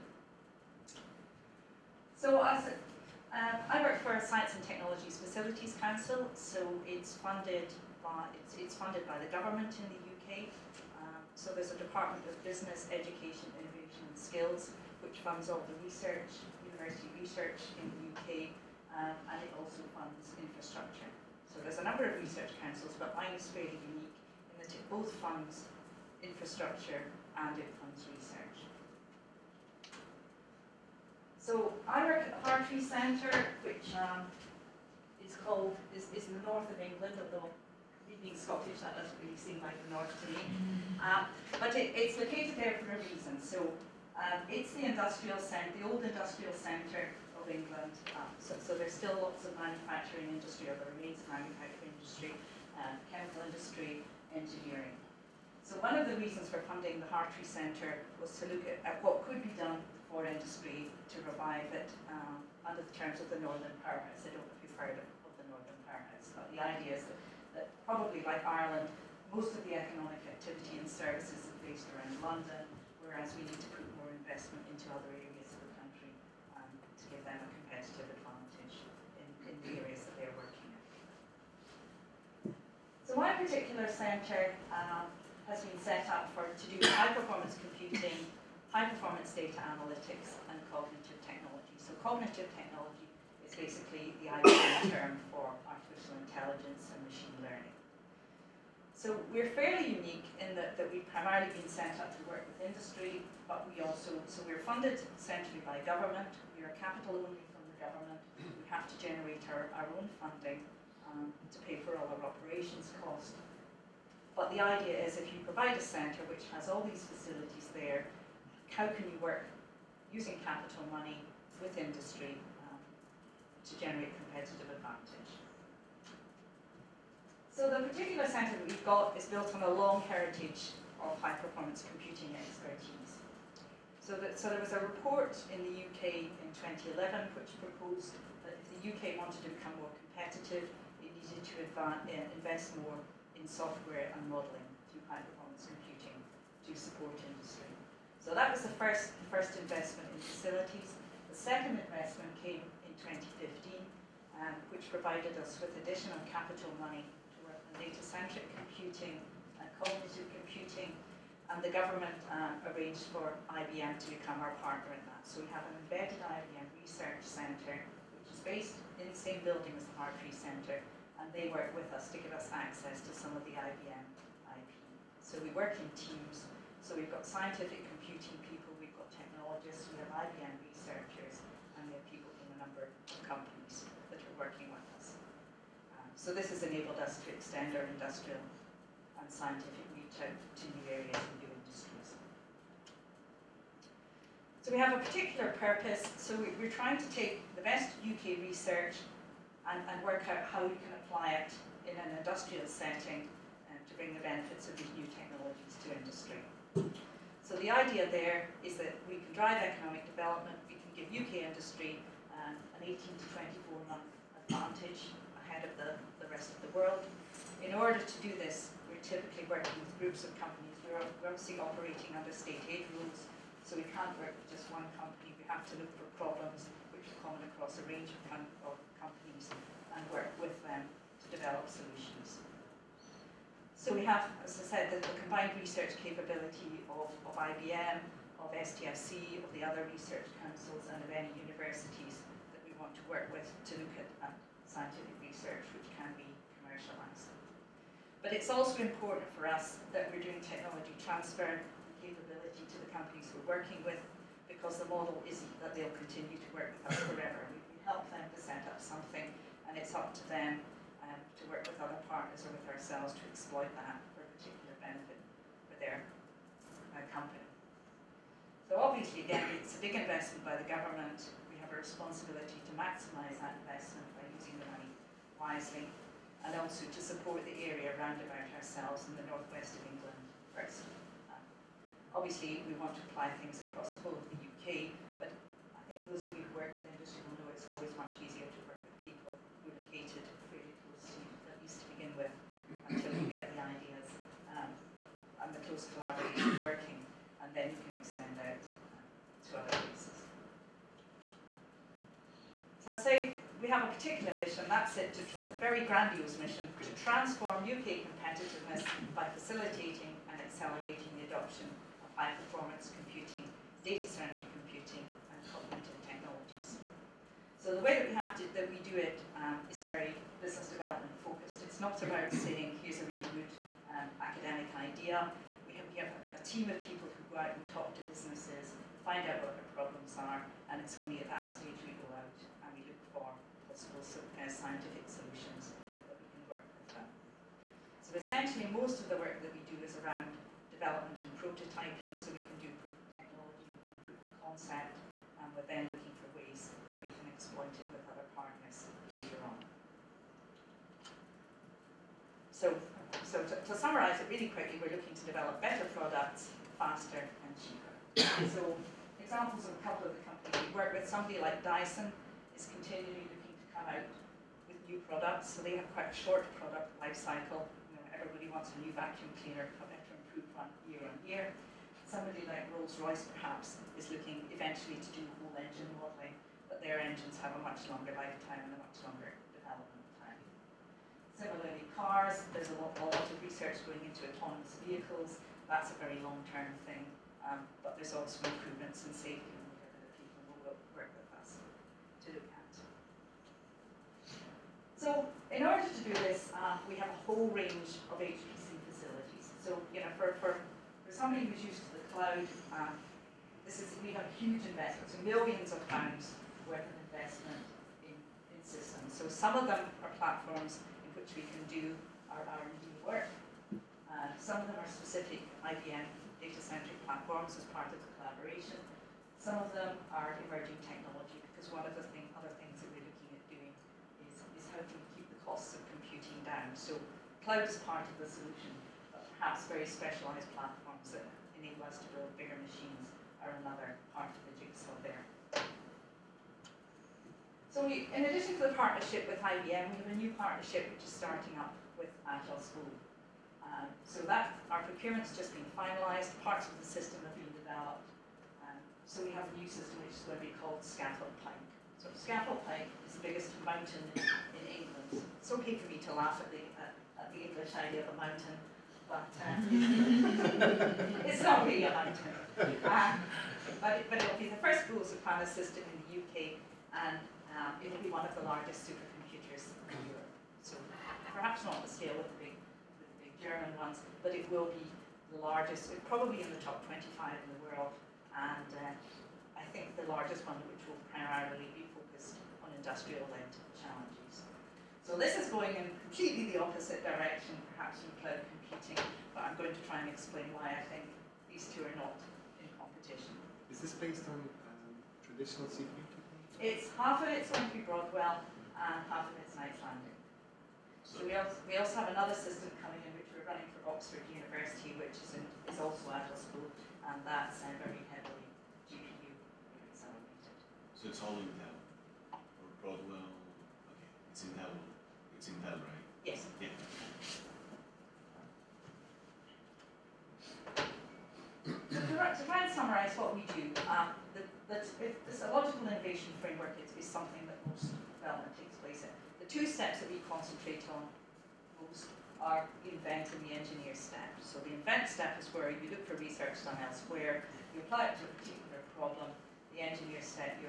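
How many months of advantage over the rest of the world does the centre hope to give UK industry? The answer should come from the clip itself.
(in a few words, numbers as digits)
18 to 24.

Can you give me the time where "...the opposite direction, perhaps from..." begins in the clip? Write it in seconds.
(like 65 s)
486 s.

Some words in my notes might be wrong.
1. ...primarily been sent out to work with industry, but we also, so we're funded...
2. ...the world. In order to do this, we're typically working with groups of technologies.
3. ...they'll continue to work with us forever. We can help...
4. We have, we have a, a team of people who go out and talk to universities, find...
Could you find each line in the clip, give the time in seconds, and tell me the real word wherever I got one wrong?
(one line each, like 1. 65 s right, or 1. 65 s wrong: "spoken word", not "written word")
1. 101 s right
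2. 216 s wrong: "companies", not "technologies"
3. 255 s right
4. 325 s wrong: "businesses", not "universities".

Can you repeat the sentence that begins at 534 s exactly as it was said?
So the invent step is where you look for research done elsewhere, you apply it to a particular problem.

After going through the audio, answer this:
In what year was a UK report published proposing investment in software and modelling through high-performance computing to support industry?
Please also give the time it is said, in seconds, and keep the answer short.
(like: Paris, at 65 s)
2011, at 136 s.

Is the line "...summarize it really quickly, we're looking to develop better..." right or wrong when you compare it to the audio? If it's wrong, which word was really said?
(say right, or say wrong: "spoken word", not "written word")
right.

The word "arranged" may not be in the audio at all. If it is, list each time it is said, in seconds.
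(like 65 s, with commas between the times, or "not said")
162 s.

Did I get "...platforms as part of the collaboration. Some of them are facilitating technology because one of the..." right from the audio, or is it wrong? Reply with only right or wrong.
wrong.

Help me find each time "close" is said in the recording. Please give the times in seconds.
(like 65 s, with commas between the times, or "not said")
290 s, 295 s.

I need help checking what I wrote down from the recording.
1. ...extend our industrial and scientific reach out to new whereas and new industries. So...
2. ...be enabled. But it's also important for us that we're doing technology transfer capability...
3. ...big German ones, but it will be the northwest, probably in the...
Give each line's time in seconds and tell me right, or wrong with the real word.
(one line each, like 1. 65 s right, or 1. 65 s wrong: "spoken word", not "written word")
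1. 187 s wrong: "areas", not "whereas"
2. 246 s wrong: "commercialised", not "enabled"
3. 473 s wrong: "largest", not "northwest".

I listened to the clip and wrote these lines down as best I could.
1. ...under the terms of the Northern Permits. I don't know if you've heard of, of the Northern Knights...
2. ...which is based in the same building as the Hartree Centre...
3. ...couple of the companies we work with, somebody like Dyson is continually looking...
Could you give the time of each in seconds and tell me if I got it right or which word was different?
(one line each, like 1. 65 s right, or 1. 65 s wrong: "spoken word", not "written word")
1. 62 s wrong: "Permits", not "Knights"
2. 168 s right
3. 359 s right.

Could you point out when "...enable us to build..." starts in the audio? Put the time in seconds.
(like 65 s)
431 s.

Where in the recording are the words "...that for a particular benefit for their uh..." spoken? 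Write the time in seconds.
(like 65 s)
263 s.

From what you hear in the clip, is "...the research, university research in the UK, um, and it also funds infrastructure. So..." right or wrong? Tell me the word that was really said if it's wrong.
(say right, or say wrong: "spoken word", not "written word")
right.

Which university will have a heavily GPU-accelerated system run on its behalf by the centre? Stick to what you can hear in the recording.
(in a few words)
Oxford University.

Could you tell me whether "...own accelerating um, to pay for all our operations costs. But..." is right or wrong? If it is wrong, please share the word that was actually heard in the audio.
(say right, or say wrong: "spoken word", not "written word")
wrong: "funding", not "accelerating".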